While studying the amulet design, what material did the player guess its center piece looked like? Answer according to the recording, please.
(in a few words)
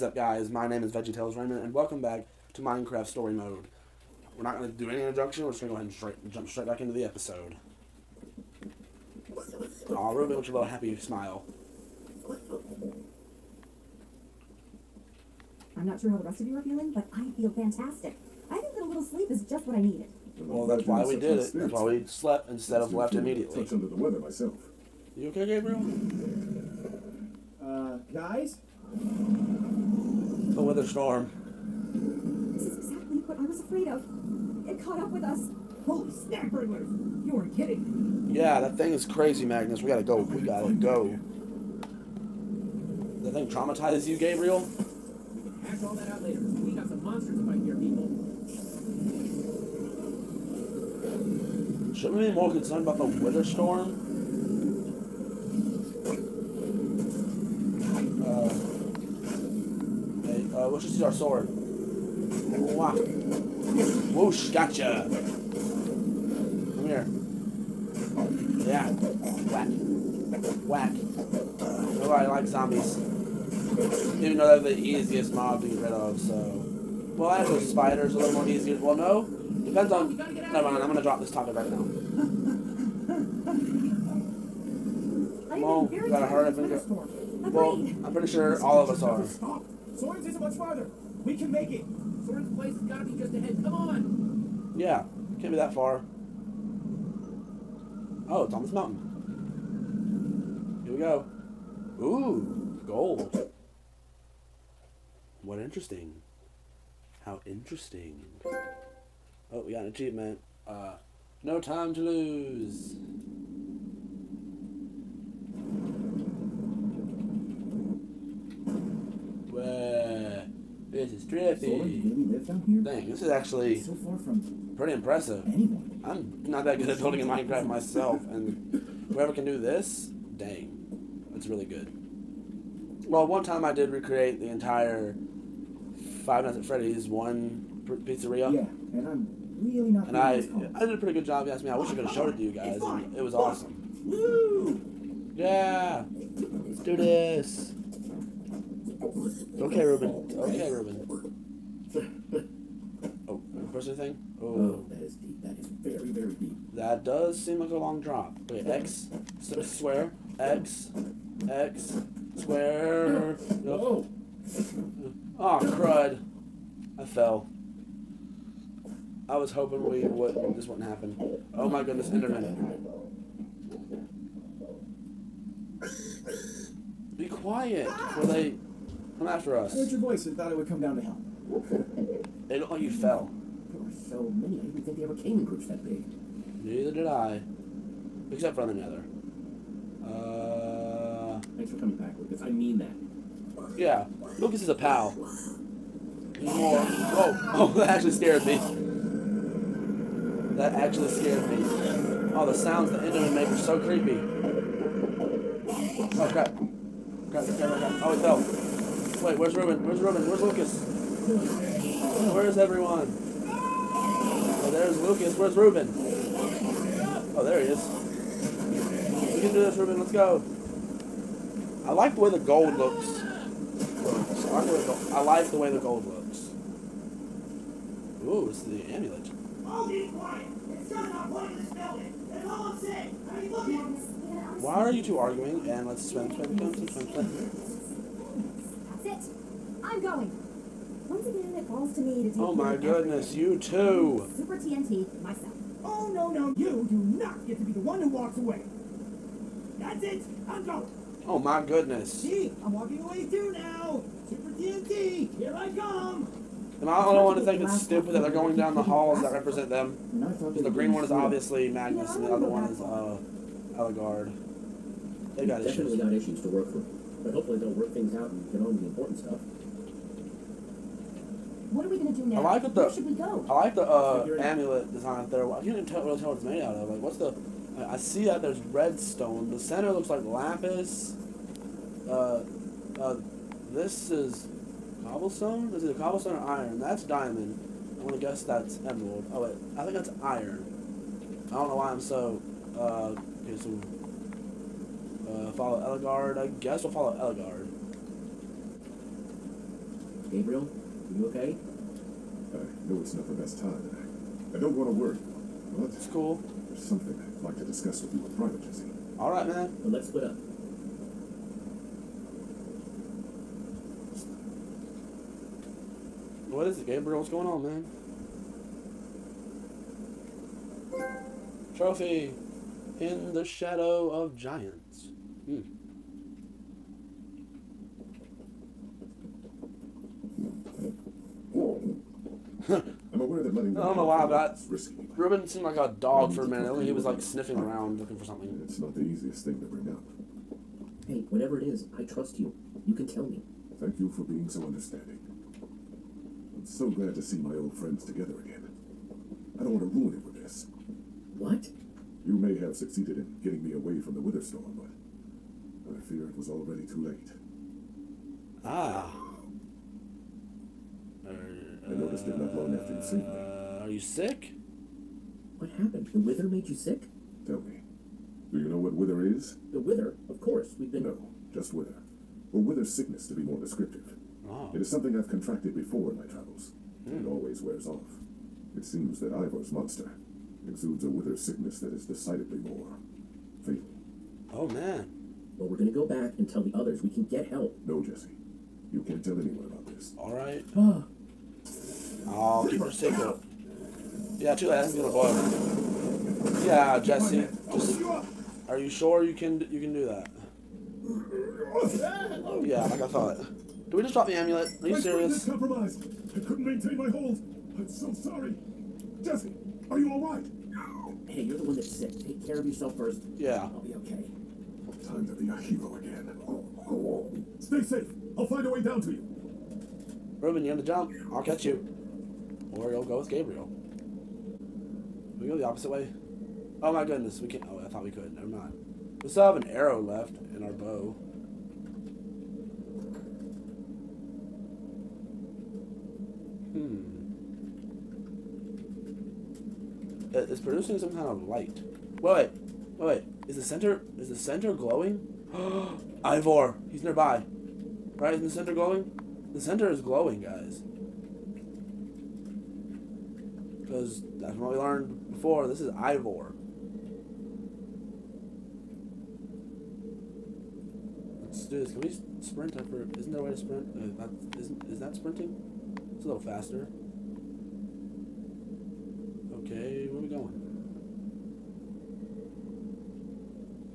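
lapis.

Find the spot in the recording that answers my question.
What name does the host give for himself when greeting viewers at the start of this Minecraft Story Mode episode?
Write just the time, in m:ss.
0:00.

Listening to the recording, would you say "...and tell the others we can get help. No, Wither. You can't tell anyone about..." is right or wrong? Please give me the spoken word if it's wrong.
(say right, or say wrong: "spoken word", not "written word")
wrong: "Jesse", not "Wither".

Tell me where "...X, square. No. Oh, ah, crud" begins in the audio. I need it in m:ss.
2:41.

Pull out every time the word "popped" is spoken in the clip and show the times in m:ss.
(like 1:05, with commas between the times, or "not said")
not said.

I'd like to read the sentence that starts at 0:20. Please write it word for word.
Well, that's why we did it.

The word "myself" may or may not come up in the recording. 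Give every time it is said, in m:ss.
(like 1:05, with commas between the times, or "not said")
0:24, 2:07, 4:05.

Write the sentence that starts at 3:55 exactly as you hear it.
And let's swim, swim, swim, swim, swim, swim.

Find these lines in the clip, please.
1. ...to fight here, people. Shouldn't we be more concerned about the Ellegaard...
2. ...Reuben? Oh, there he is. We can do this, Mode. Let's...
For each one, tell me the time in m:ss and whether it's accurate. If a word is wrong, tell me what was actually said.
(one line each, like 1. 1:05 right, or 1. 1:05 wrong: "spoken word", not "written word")
1. 0:47 wrong: "Wither", not "Ellegaard"
2. 3:35 wrong: "Reuben", not "Mode".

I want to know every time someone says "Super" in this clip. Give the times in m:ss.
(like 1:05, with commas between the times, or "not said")
4:04, 4:14.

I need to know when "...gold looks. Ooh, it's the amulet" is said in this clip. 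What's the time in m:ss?
3:45.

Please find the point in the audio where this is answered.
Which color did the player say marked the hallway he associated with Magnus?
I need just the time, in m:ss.
4:20.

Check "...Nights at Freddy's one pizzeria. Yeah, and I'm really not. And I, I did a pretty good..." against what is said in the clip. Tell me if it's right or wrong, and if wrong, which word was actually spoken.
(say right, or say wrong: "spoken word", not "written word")
right.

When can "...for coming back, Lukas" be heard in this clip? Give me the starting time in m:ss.
3:11.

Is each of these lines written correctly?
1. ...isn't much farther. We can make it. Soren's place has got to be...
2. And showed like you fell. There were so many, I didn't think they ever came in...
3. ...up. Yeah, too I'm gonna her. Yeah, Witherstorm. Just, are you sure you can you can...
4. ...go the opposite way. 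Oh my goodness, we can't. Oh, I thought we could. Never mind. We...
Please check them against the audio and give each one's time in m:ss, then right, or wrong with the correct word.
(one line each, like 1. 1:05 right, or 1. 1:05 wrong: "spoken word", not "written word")
1. 1:30 right
2. 3:02 wrong: "looked", not "showed"
3. 6:33 wrong: "Jesse", not "Witherstorm"
4. 7:05 right.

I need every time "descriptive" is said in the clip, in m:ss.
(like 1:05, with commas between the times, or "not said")
6:13.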